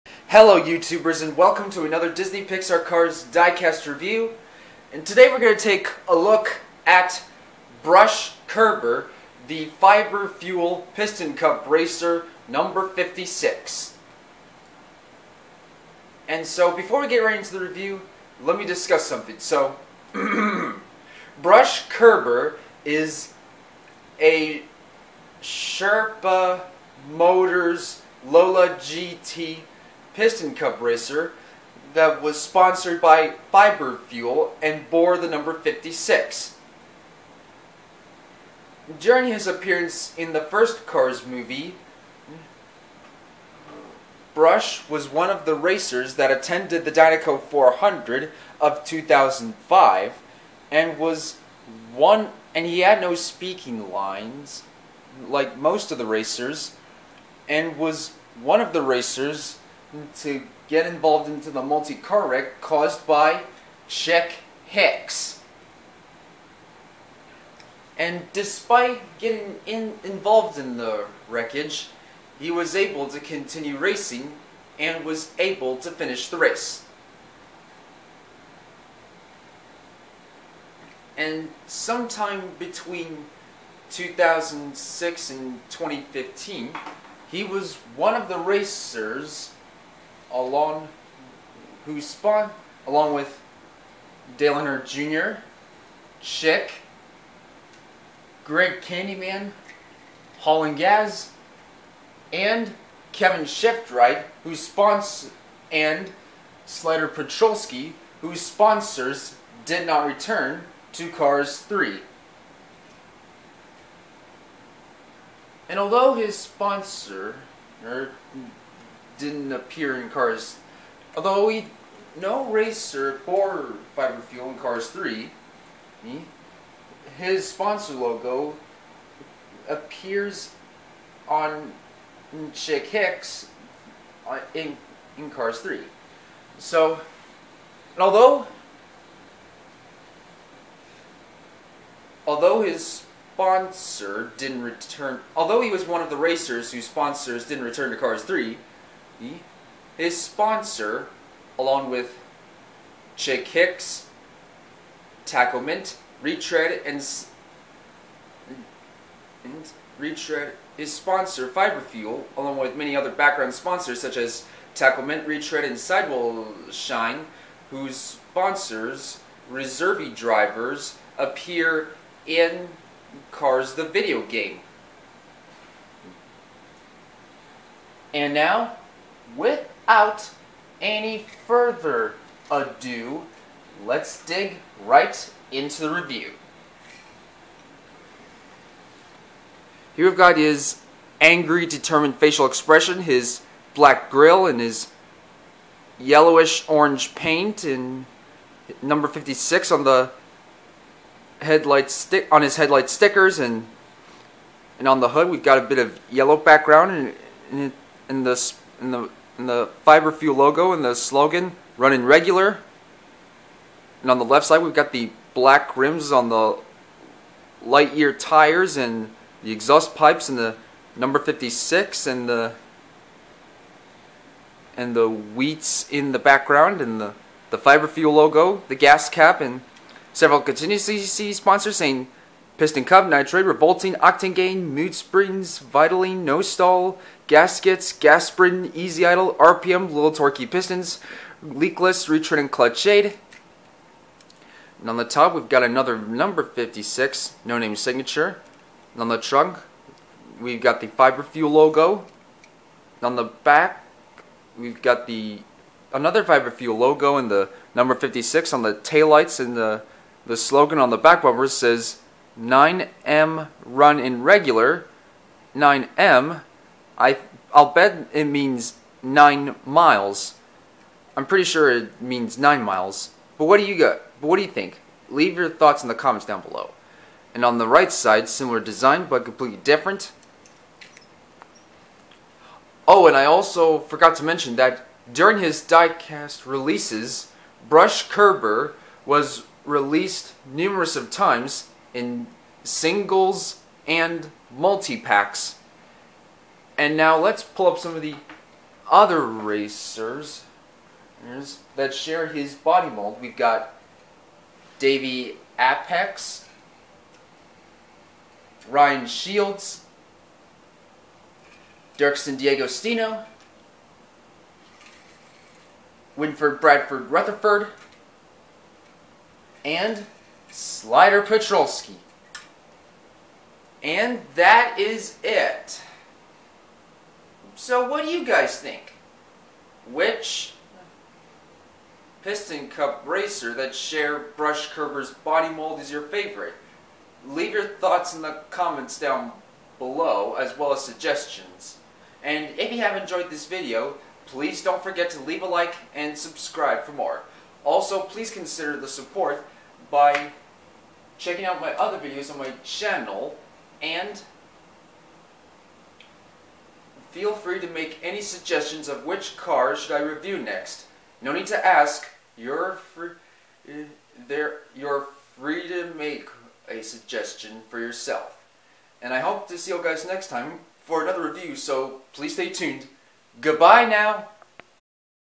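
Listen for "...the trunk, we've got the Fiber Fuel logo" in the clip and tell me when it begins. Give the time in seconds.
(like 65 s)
249 s.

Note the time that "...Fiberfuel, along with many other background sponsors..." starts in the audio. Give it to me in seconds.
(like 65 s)
161 s.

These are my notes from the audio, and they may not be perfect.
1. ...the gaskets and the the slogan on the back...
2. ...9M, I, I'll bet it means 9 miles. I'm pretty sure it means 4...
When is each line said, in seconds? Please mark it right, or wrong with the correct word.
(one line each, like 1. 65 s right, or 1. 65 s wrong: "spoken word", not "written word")
1. 258 s wrong: "taillights", not "gaskets"
2. 265 s wrong: "9", not "4".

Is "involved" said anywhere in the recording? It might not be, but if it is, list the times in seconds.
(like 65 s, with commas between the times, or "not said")
60 s, 70 s.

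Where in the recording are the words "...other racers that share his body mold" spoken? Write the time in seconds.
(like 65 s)
298 s.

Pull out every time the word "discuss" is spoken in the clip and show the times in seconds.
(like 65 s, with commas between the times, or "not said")
18 s.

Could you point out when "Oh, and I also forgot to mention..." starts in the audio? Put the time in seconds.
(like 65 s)
282 s.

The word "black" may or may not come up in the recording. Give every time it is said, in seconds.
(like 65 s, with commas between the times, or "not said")
193 s, 215 s.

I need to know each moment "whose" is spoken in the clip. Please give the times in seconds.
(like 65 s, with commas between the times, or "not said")
91 s, 108 s, 146 s, 167 s.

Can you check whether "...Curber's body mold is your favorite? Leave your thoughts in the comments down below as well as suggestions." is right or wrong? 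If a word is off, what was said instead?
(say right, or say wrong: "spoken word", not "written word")
right.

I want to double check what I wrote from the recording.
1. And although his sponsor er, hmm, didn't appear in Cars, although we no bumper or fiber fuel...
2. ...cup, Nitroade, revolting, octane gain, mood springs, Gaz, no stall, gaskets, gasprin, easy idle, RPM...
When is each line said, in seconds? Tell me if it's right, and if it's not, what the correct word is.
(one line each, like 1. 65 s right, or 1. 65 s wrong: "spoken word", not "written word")
1. 115 s wrong: "racer", not "bumper"
2. 232 s wrong: "Vitoline", not "Gaz".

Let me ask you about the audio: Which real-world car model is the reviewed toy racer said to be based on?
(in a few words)
Lola GT.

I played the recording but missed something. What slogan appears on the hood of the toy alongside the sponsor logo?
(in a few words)
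Running regular.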